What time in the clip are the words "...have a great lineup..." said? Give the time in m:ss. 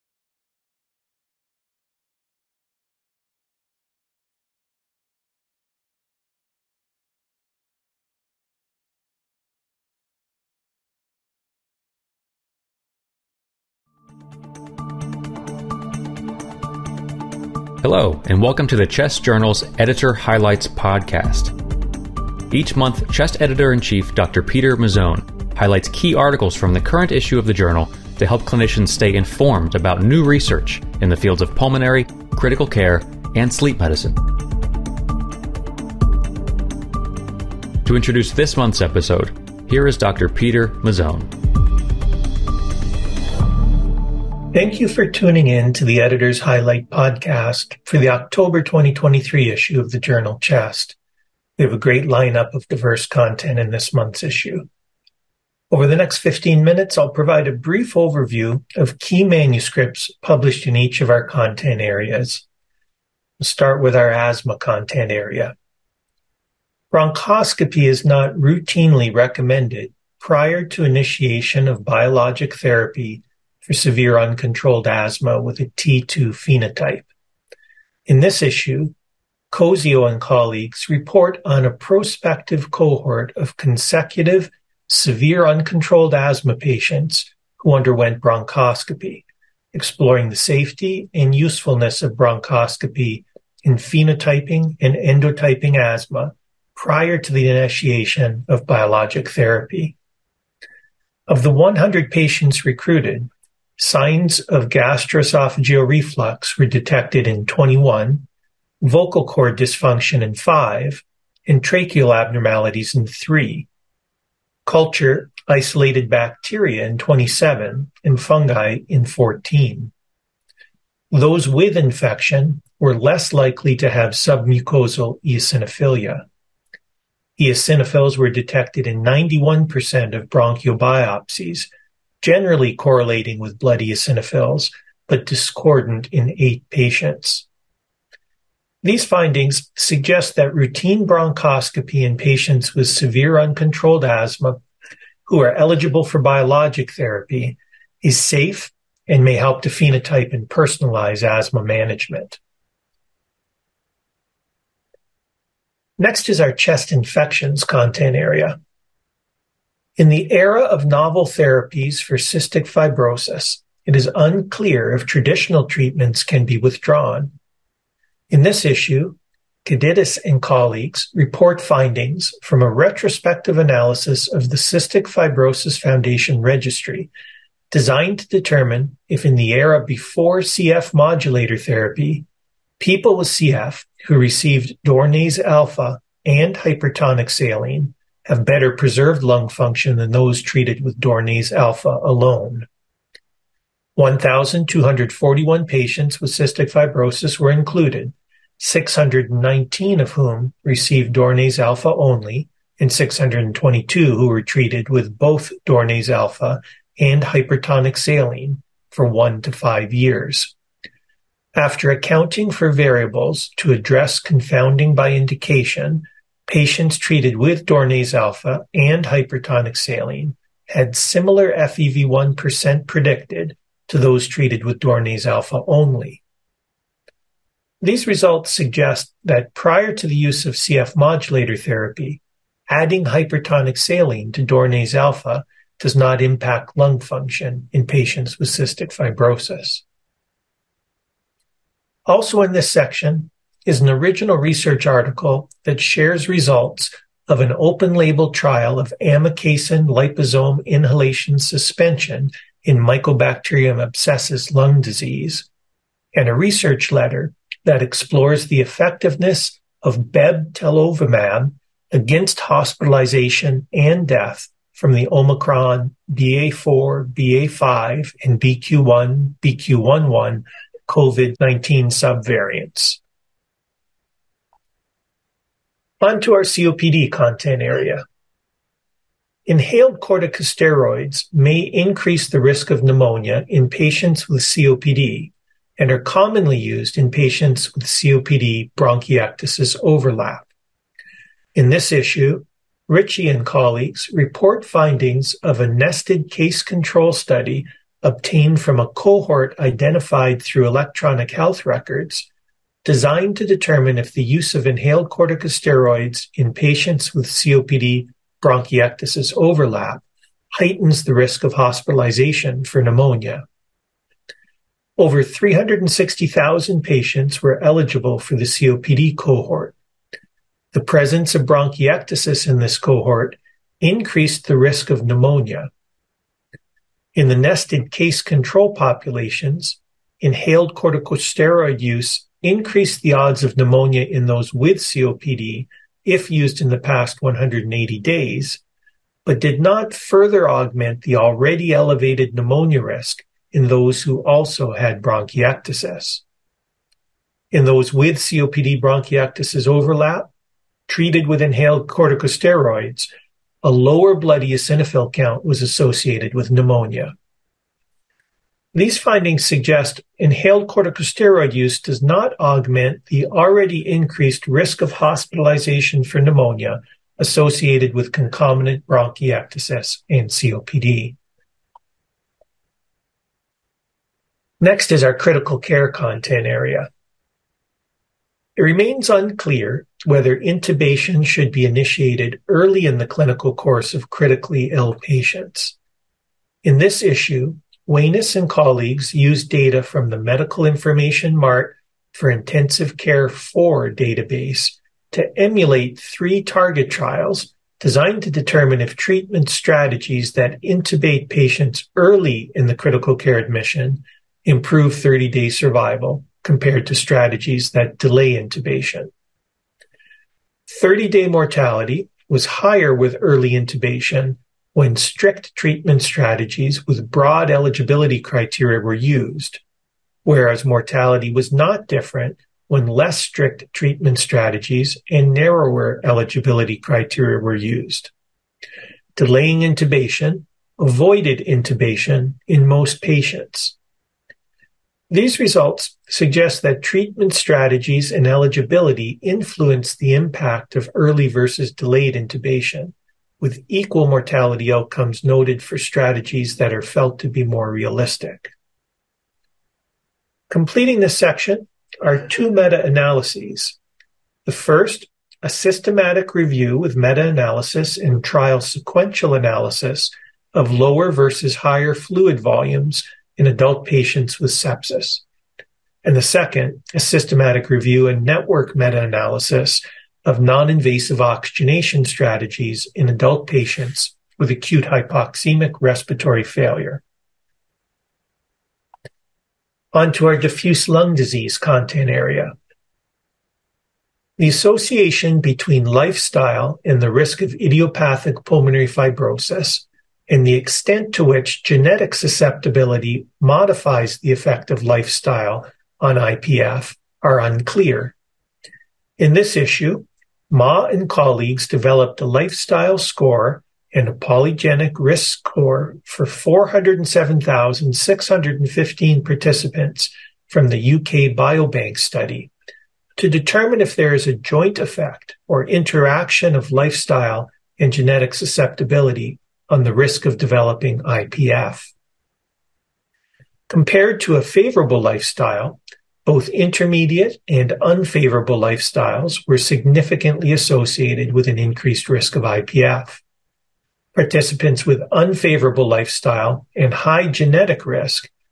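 0:51.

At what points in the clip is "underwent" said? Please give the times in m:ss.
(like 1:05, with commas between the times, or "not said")
1:27.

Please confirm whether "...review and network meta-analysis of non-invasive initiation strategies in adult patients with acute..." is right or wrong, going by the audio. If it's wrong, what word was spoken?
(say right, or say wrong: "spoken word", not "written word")
wrong: "oxygenation", not "initiation".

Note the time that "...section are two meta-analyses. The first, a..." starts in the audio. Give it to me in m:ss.
7:31.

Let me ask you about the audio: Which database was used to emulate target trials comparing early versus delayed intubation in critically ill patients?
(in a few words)
Medical Information Mart for Intensive Care 4.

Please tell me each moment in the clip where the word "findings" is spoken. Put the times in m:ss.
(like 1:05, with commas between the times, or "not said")
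2:19, 2:51, 4:54, 5:58.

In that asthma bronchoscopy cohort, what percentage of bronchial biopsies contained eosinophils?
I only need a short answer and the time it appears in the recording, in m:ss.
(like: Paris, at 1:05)
91%, at 2:09.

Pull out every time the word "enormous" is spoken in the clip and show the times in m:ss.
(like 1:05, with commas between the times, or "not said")
not said.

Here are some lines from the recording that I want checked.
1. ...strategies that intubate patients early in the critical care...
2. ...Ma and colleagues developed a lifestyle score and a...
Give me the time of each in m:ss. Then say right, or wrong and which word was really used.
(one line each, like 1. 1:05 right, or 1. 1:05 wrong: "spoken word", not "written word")
1. 6:39 right
2. 8:20 right.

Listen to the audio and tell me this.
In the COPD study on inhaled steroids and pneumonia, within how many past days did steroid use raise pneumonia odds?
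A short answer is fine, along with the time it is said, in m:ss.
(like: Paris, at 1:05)
180, at 5:37.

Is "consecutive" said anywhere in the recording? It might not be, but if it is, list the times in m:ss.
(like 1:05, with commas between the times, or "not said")
1:23.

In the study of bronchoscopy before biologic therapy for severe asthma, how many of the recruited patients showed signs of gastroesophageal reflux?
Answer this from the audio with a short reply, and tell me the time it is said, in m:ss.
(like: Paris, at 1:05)
21, at 1:47.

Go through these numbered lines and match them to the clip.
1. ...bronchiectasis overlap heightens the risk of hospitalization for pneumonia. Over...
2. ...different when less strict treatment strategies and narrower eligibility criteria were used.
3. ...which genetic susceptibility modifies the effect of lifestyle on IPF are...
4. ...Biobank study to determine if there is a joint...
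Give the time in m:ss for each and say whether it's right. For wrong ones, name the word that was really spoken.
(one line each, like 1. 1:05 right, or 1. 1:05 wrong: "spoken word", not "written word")
1. 5:08 right
2. 7:01 right
3. 8:11 right
4. 8:31 right.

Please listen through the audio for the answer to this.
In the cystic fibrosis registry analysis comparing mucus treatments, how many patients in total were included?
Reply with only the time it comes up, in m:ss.
3:13.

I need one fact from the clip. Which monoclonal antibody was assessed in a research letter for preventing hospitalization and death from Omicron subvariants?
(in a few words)
bebtelovimab.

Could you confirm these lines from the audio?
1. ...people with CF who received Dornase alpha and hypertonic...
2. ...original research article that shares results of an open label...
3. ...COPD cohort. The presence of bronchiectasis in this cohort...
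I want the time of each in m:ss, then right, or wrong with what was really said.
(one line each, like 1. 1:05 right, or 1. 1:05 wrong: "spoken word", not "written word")
1. 3:02 right
2. 4:03 right
3. 5:18 right.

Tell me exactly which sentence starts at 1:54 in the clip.
Culture isolated bacteria in 27 and fungi in 14.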